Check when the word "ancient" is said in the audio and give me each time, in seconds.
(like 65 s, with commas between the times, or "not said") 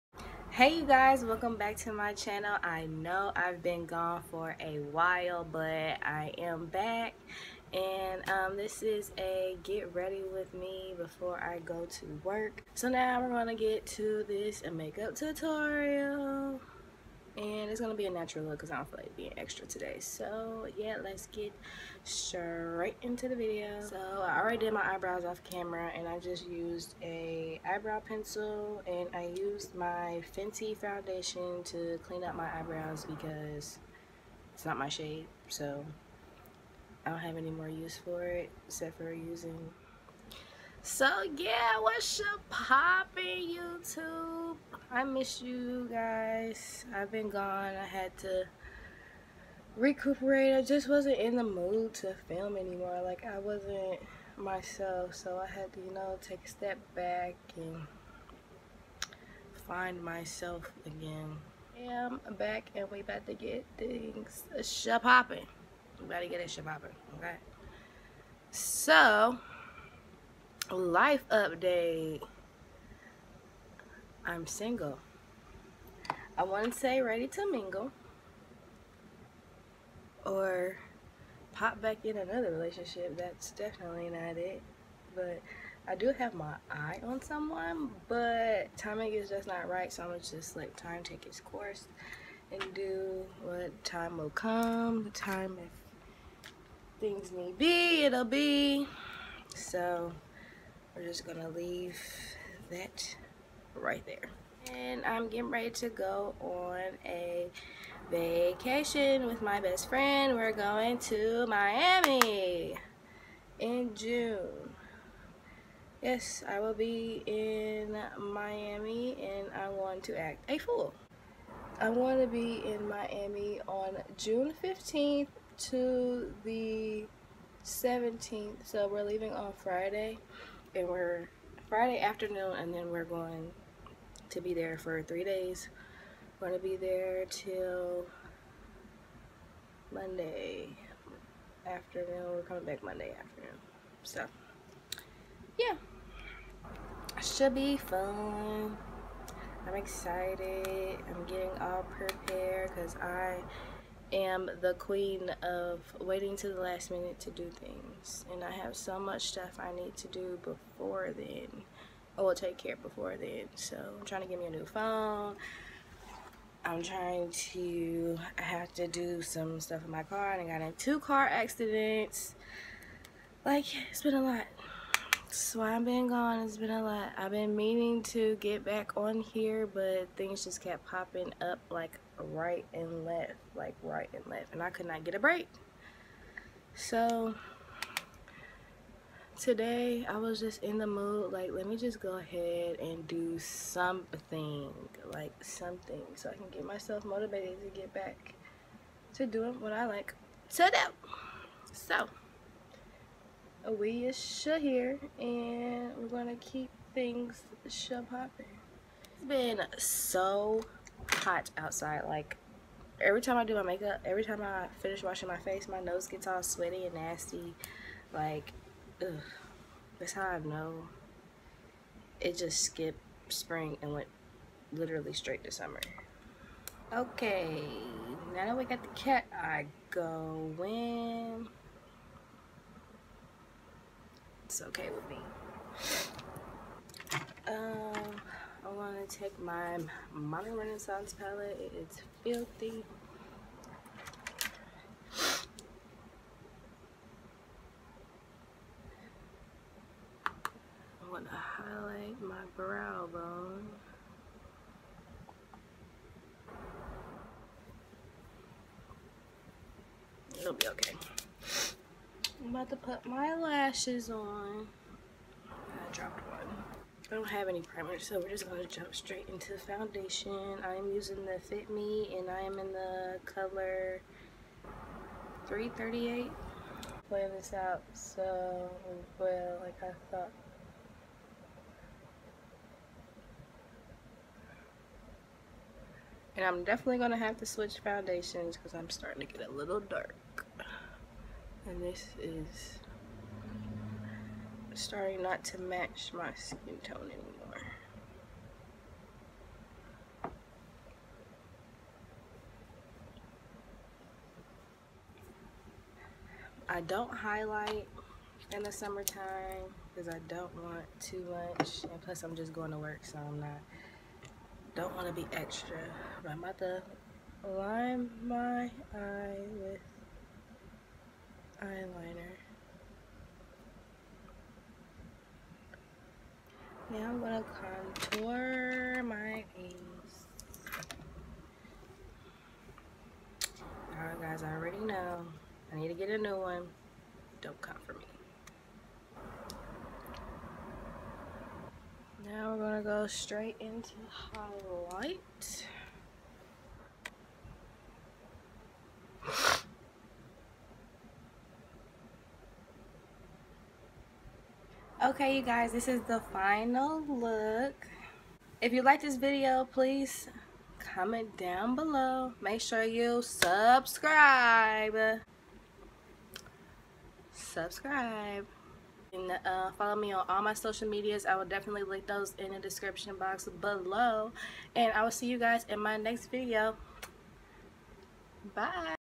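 not said.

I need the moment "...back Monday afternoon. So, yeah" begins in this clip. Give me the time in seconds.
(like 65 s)
142 s.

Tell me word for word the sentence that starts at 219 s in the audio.
that's how I know it just skipped spring and went literally straight to summer.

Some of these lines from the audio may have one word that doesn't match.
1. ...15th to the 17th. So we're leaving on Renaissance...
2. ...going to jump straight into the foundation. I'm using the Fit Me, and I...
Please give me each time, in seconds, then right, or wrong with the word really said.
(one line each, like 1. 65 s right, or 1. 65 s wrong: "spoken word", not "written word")
1. 124 s wrong: "Friday", not "Renaissance"
2. 268 s right.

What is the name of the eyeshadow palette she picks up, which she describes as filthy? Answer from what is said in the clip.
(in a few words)
Modern Renaissance.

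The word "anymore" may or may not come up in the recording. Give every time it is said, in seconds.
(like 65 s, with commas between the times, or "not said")
52 s, 297 s.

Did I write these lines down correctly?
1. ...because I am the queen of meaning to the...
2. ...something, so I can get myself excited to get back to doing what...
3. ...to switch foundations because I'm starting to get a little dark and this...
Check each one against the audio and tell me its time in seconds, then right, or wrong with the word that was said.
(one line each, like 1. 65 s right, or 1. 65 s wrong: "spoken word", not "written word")
1. 152 s wrong: "waiting", not "meaning"
2. 195 s wrong: "motivated", not "excited"
3. 287 s right.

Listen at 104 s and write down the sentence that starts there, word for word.
And I'm getting ready to go on a vacation with my best friend.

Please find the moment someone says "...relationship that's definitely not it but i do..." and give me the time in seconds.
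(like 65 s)
82 s.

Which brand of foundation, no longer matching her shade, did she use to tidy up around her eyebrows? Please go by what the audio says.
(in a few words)
Fenty.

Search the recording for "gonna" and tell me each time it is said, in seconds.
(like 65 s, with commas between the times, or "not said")
13 s, 17 s, 90 s, 101 s, 206 s.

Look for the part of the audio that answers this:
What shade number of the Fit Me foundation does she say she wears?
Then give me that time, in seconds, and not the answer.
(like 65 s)
275 s.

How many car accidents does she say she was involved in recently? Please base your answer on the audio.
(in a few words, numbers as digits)
2.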